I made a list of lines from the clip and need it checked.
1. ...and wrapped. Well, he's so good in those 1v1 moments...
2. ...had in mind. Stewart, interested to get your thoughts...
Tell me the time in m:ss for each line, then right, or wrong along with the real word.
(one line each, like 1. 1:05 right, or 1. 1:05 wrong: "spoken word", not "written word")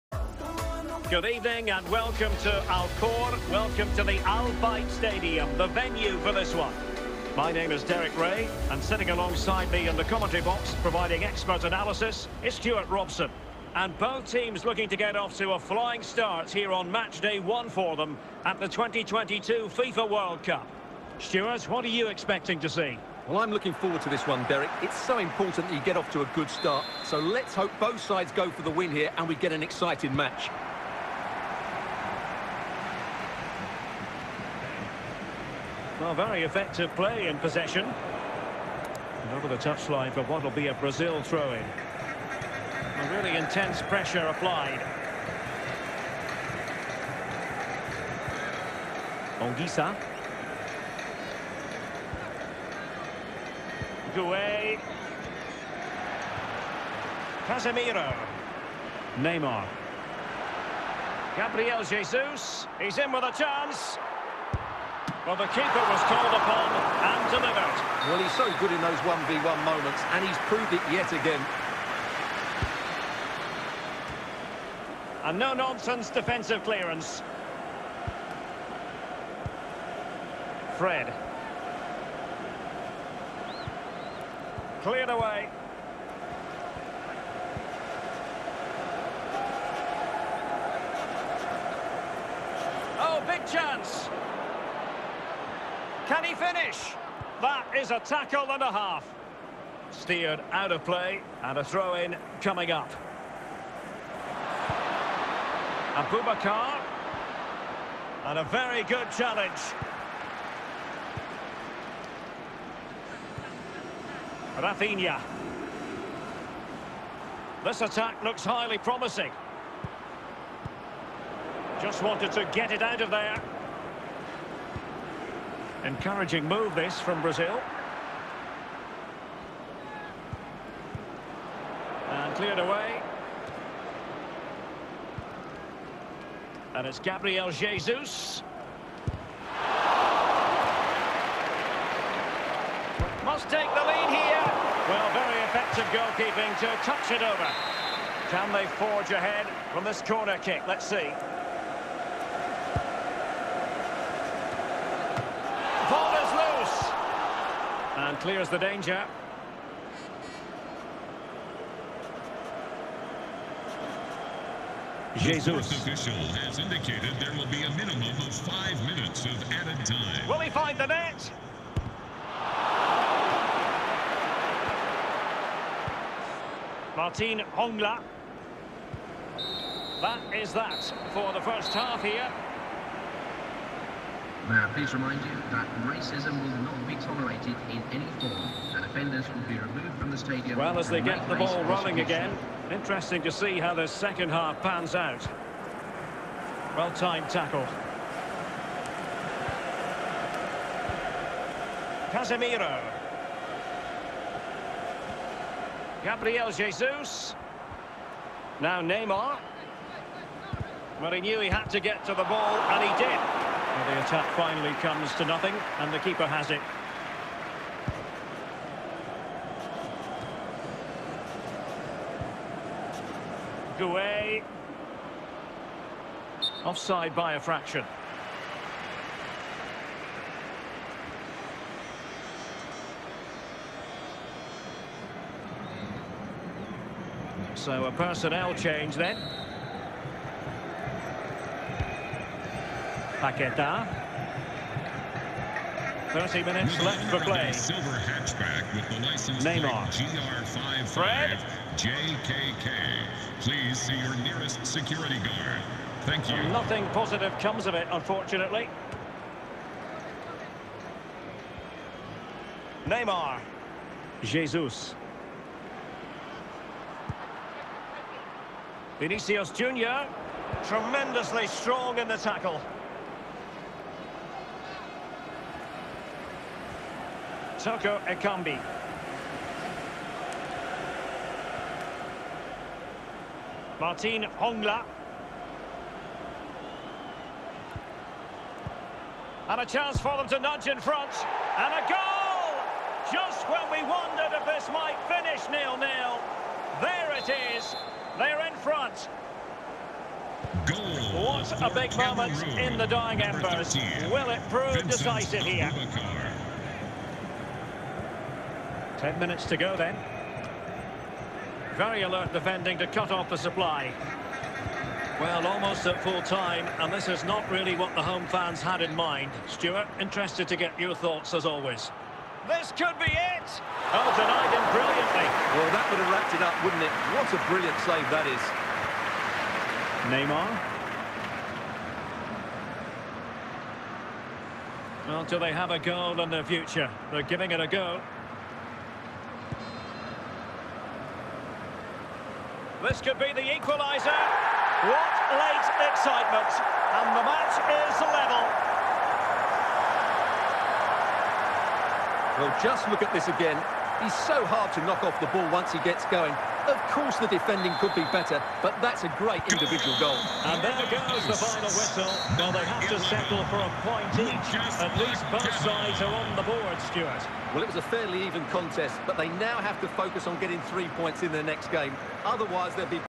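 1. 1:07 wrong: "delivered", not "wrapped"
2. 5:18 right.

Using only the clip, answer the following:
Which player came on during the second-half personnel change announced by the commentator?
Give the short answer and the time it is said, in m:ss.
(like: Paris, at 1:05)
Paqueta, at 4:03.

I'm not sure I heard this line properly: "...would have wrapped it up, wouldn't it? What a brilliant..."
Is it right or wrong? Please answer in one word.
right.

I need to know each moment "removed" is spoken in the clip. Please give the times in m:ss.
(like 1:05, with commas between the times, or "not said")
3:09.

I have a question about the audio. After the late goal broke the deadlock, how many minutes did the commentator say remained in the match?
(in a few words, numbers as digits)
10.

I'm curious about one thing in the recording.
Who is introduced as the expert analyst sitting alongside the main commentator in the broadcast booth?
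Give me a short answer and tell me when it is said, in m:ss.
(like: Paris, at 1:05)
Stewart Robson, at 0:12.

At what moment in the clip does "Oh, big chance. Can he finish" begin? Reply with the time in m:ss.
1:32.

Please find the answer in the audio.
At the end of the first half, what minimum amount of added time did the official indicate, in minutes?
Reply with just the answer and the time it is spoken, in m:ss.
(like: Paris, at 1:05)
5, at 2:48.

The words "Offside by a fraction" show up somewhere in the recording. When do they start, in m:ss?
3:46.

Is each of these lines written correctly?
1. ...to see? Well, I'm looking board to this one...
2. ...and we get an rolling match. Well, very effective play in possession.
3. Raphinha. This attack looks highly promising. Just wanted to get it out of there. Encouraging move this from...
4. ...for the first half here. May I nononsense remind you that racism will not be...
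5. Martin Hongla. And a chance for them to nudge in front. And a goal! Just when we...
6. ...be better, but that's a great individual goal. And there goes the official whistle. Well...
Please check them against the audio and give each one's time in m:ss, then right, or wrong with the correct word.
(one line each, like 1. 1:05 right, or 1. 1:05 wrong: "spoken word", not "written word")
1. 0:22 wrong: "forward", not "board"
2. 0:29 wrong: "exciting", not "rolling"
3. 1:54 right
4. 3:01 wrong: "please", not "nononsense"
5. 4:43 right
6. 5:57 wrong: "final", not "official".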